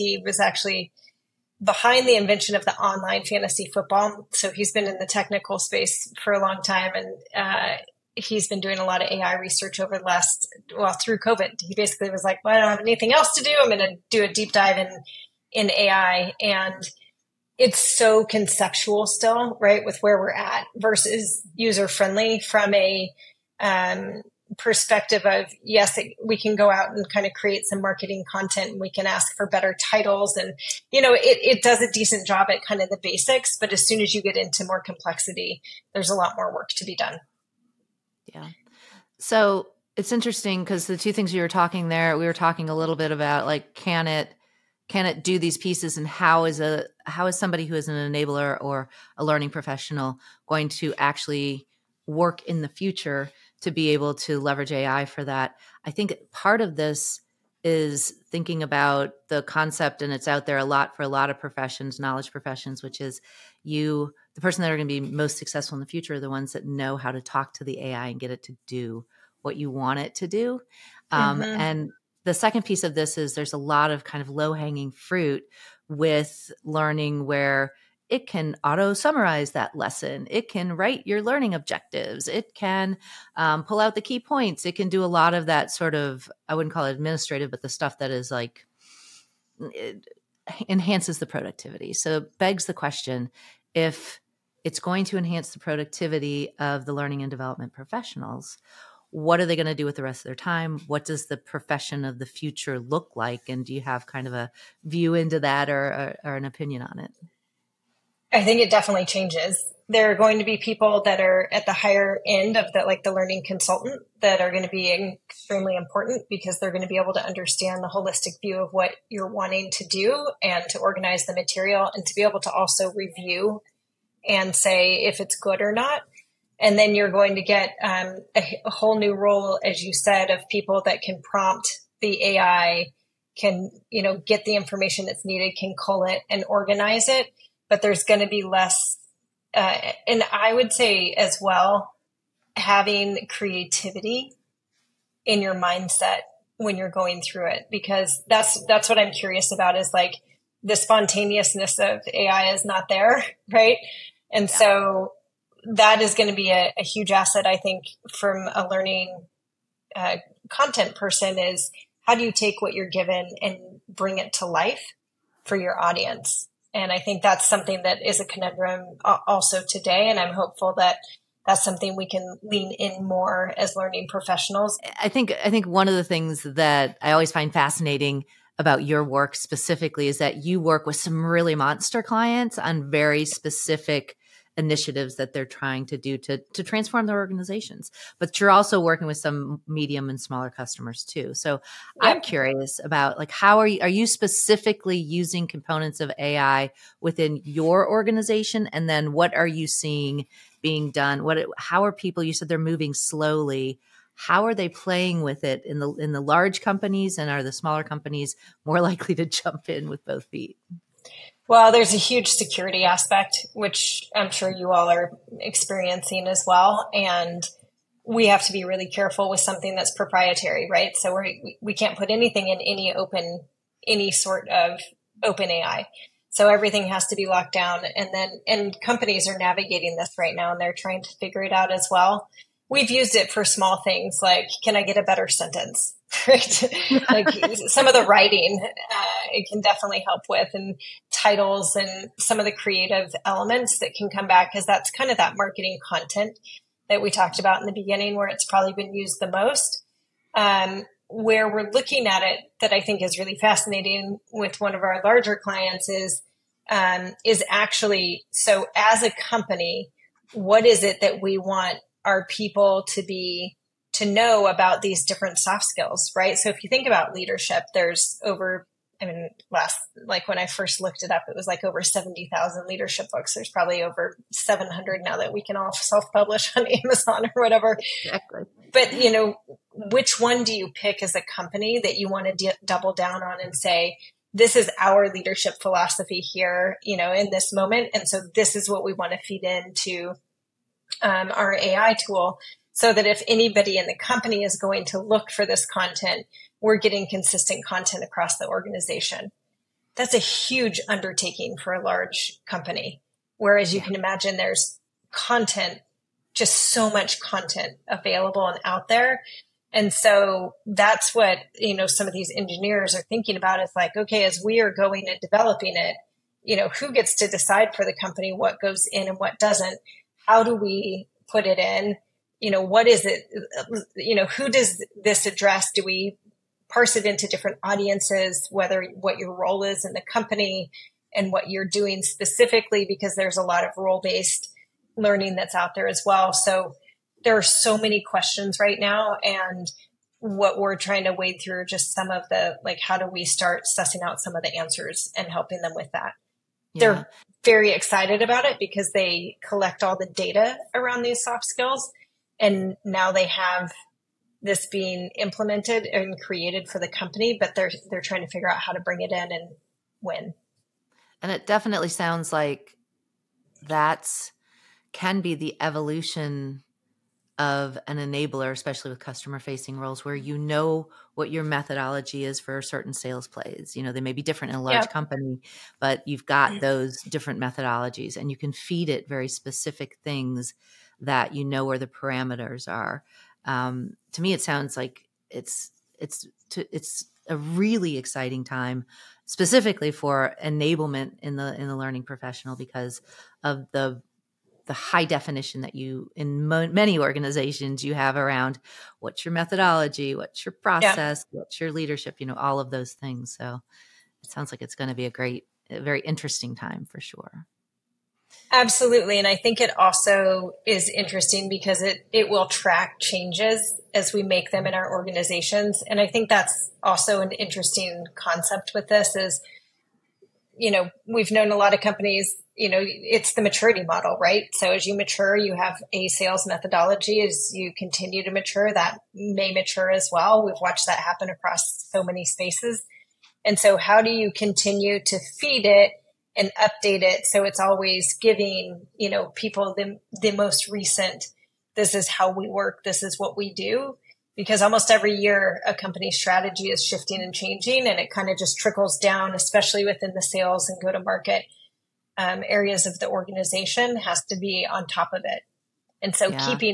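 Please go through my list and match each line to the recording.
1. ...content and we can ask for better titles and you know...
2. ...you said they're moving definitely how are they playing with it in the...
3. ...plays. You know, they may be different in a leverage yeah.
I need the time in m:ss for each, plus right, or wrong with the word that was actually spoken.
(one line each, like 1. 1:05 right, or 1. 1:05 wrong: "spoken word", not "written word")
1. 0:28 right
2. 3:22 wrong: "slowly", not "definitely"
3. 6:13 wrong: "large", not "leverage".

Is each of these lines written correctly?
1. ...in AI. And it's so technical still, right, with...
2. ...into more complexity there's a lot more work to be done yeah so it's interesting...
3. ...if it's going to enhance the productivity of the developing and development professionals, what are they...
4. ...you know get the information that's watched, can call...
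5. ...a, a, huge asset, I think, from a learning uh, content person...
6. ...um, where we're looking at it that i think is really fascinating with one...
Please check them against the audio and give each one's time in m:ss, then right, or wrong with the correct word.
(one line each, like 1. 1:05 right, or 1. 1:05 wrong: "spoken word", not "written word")
1. 0:15 wrong: "conceptual", not "technical"
2. 0:34 right
3. 1:33 wrong: "learning", not "developing"
4. 2:13 wrong: "needed", not "watched"
5. 2:36 right
6. 4:10 right.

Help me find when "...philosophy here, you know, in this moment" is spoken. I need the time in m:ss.
4:45.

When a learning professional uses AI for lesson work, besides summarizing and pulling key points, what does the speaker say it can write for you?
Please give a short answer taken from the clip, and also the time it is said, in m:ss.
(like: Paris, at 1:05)
learning objectives, at 1:21.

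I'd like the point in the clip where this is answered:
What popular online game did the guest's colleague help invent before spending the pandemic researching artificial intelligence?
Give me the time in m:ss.
0:02.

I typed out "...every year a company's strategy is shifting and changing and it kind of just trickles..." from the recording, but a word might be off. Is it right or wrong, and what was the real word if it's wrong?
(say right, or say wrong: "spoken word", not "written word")
right.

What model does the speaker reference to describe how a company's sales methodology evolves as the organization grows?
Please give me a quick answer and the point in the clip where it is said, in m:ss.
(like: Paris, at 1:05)
maturity model, at 7:03.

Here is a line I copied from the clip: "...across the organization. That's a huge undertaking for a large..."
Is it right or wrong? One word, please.
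right.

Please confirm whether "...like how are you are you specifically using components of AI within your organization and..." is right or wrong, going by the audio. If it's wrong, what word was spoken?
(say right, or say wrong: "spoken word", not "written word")
right.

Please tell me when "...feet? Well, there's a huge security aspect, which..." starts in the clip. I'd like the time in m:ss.
3:30.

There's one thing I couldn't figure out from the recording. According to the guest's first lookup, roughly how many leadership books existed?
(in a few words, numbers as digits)
70,000.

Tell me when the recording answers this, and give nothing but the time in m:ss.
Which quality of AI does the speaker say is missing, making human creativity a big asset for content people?
2:30.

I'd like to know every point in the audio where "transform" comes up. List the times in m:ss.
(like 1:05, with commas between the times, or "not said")
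3:06.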